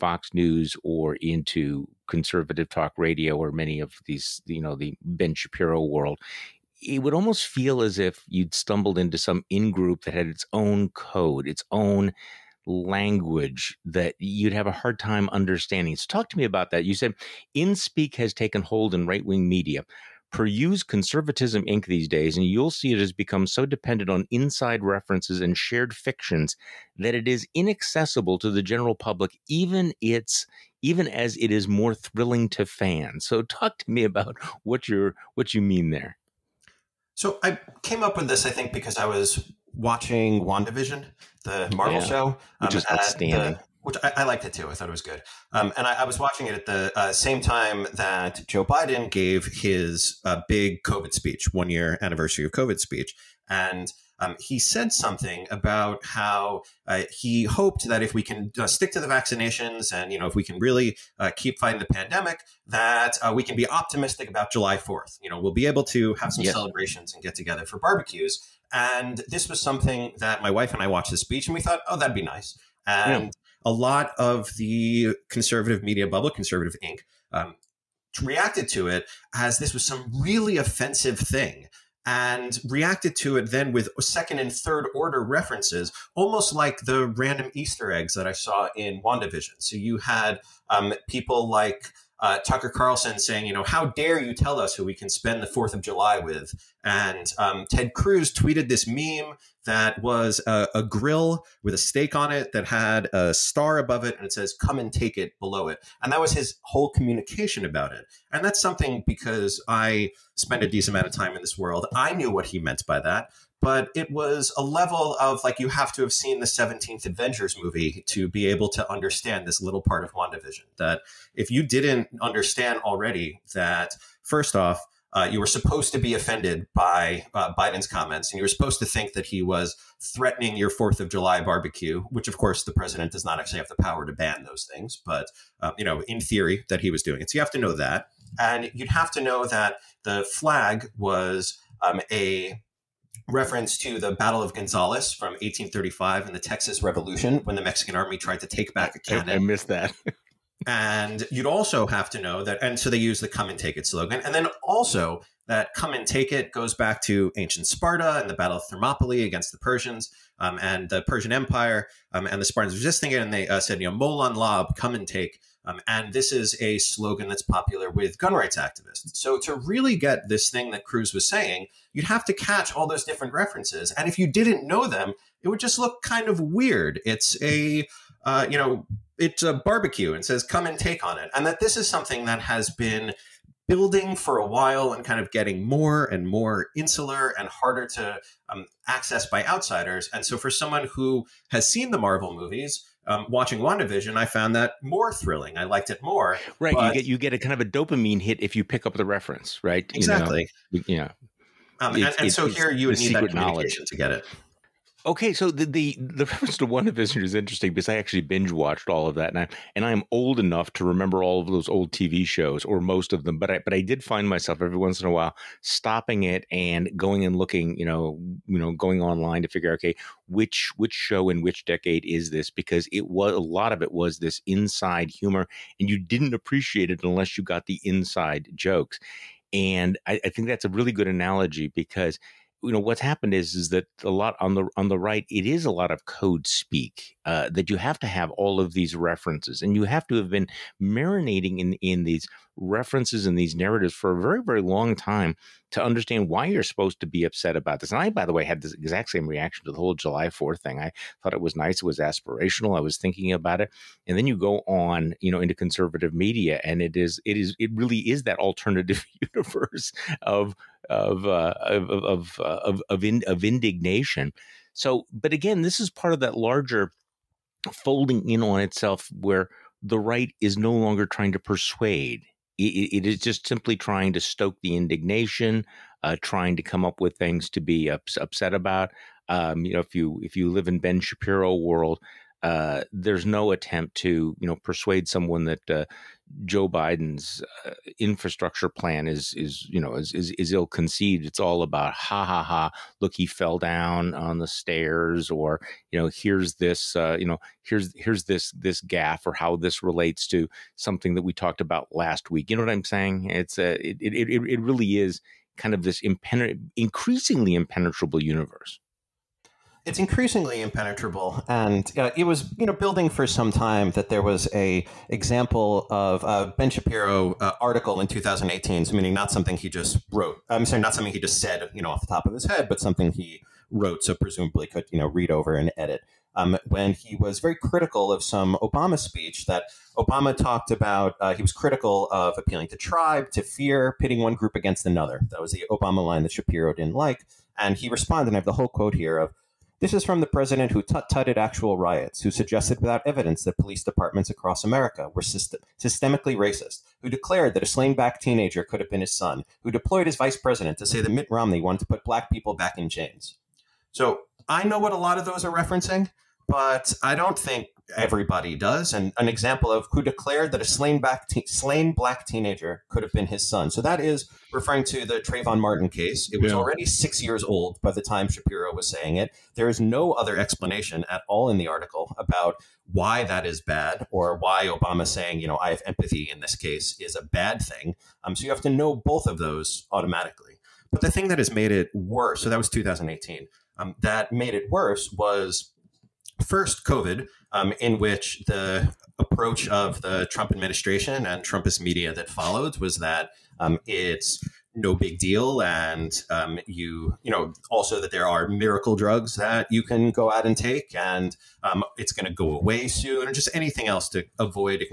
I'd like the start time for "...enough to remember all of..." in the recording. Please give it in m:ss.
3:30.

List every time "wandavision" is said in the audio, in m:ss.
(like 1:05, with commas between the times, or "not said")
0:40, 1:29, 2:00, 3:13, 3:26.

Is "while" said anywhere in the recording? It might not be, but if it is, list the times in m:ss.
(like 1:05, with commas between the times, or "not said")
3:04, 3:35.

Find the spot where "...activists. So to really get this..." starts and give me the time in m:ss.
2:48.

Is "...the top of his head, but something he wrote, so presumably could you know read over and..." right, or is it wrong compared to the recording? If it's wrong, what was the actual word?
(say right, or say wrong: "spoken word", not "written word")
right.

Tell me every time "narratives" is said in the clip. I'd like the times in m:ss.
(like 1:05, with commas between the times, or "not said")
4:03.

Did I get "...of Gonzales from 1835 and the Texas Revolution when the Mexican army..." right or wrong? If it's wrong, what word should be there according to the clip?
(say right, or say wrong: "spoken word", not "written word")
right.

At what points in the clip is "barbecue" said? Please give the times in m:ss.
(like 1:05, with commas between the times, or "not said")
1:07, 2:11, 2:59.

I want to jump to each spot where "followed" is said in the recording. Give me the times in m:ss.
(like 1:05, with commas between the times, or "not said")
6:32.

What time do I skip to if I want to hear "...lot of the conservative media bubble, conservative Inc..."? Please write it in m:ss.
1:13.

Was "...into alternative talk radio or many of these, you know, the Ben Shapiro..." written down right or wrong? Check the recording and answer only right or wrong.
wrong.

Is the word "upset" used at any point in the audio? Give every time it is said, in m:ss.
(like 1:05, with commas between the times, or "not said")
4:07, 4:38.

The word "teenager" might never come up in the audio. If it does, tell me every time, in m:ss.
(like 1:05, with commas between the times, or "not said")
5:48, 6:02.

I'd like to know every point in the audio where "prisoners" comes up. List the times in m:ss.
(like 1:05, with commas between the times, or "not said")
not said.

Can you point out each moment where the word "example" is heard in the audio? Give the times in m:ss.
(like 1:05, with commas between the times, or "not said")
5:15, 5:59.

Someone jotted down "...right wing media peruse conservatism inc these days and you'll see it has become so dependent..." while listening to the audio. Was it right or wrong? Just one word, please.
right.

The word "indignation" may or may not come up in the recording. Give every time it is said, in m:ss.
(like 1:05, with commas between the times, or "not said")
4:23, 4:34.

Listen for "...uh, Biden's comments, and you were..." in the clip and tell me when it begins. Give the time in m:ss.
2:07.